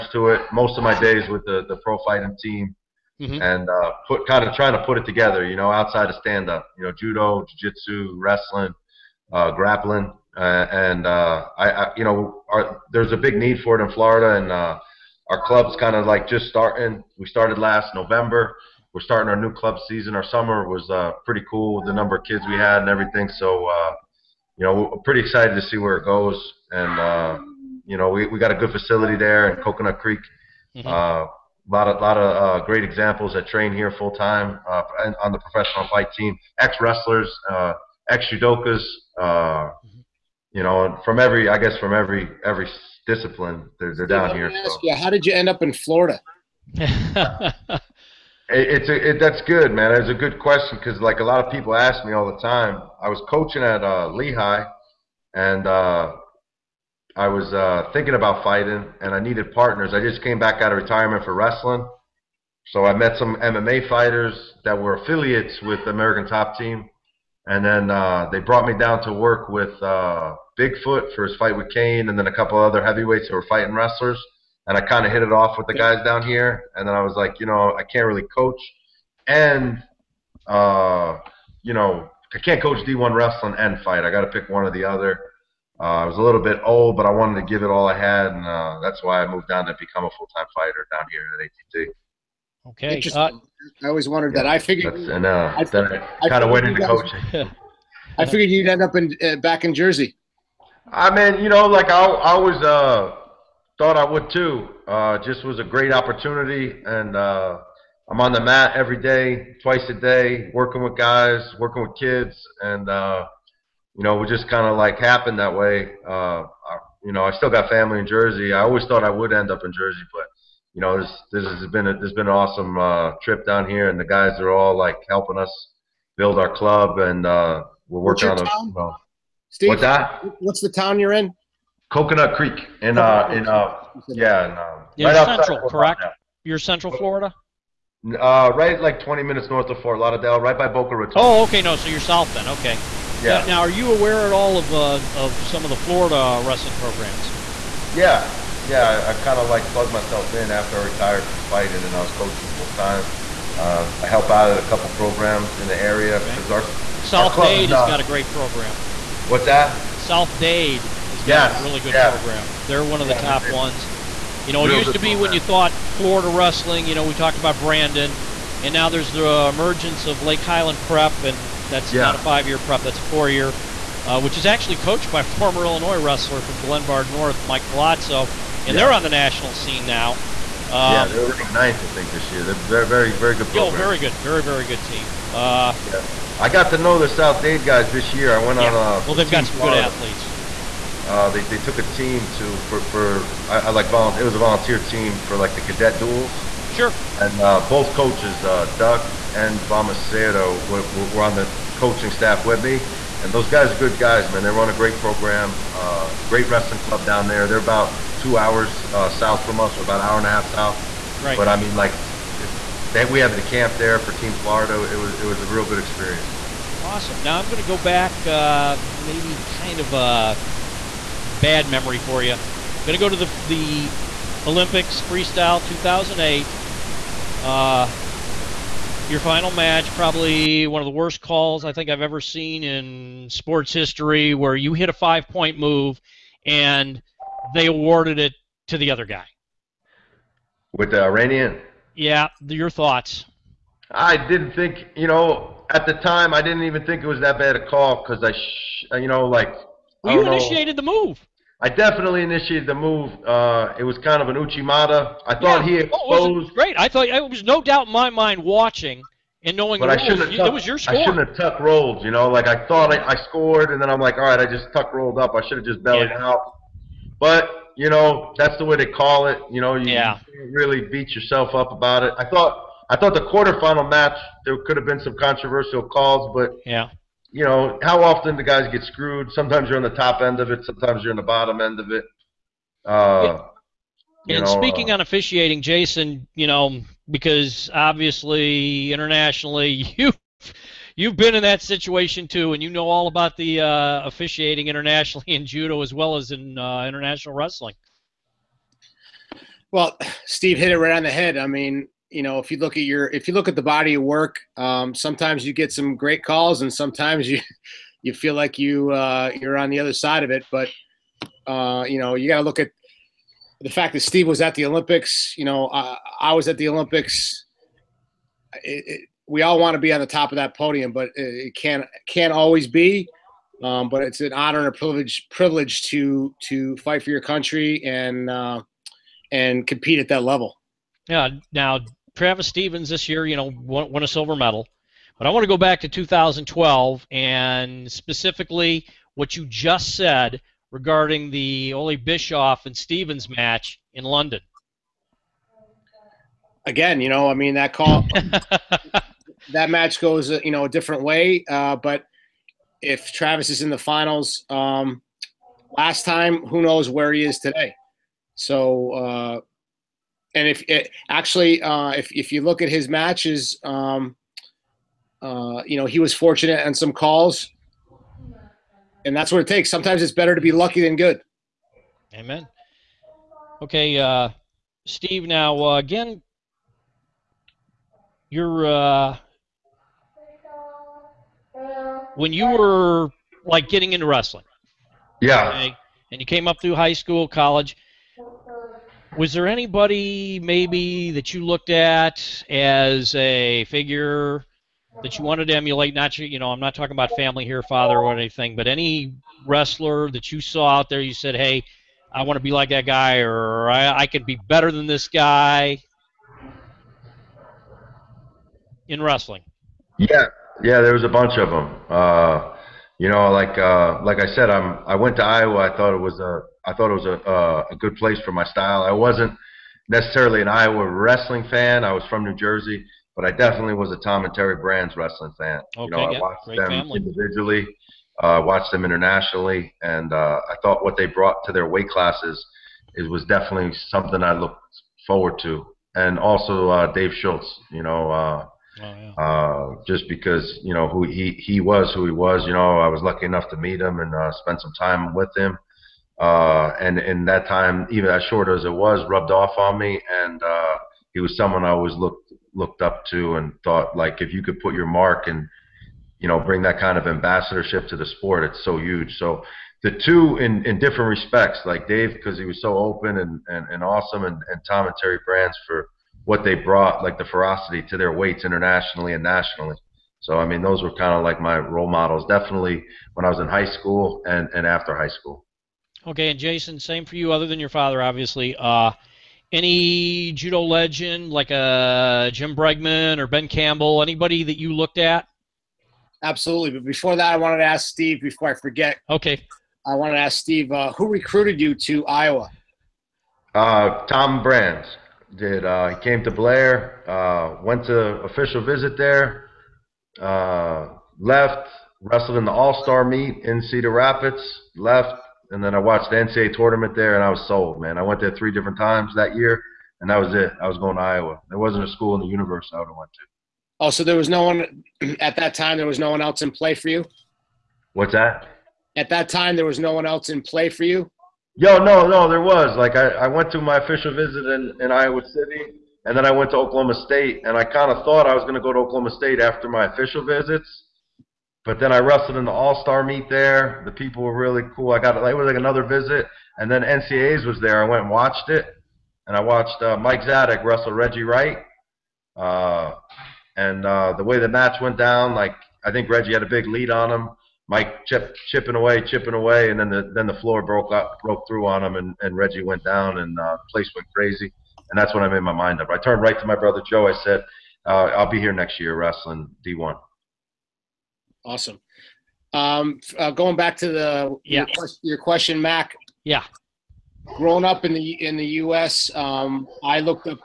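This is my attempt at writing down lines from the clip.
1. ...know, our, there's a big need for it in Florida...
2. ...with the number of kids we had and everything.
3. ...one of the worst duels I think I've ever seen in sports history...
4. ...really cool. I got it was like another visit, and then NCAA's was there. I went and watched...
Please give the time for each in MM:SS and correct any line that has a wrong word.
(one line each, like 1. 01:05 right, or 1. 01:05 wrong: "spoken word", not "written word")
1. 00:12 right
2. 00:21 right
3. 03:50 wrong: "calls", not "duels"
4. 08:54 right.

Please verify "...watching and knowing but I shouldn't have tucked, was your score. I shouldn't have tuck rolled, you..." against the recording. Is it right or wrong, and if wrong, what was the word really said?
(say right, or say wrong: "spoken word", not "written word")
right.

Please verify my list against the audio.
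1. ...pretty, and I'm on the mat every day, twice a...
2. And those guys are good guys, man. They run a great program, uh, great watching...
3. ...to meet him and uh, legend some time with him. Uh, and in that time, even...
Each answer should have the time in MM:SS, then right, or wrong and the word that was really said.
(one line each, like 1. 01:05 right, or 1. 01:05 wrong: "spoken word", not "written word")
1. 01:45 wrong: "opportunity", not "pretty"
2. 03:23 wrong: "wrestling", not "watching"
3. 07:23 wrong: "spend", not "legend".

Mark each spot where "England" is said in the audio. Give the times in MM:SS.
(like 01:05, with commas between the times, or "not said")
not said.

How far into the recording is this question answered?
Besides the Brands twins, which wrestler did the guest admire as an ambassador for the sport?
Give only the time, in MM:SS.
07:16.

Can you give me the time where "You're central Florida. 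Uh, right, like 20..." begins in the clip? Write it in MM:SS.
02:16.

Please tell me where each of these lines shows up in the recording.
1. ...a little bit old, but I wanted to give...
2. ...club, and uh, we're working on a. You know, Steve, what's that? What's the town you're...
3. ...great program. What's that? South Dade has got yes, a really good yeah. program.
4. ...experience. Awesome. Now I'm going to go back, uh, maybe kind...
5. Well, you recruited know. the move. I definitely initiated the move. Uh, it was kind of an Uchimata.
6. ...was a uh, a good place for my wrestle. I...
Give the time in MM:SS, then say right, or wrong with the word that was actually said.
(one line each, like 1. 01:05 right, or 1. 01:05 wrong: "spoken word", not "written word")
1. 01:26 right
2. 02:06 right
3. 02:38 right
4. 03:35 right
5. 04:10 wrong: "initiated", not "recruited"
6. 06:56 wrong: "style", not "wrestle".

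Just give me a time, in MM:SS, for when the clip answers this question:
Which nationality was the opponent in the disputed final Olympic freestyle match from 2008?
04:00.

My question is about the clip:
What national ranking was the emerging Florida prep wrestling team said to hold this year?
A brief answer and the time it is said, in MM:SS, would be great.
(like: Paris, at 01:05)
9th, at 03:01.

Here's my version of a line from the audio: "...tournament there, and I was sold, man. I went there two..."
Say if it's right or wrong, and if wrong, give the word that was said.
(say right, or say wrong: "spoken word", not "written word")
wrong: "three", not "two".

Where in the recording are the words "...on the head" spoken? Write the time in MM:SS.
05:00.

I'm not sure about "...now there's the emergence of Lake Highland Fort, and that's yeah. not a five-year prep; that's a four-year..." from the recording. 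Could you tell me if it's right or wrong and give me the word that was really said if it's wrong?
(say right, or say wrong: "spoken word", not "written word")
wrong: "Prep", not "Fort".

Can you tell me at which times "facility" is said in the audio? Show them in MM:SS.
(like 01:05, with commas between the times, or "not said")
00:28.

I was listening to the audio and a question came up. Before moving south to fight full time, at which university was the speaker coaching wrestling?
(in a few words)
Lehigh.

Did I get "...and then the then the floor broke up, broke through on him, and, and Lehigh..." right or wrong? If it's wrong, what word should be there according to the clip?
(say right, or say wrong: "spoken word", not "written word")
wrong: "Reggie", not "Lehigh".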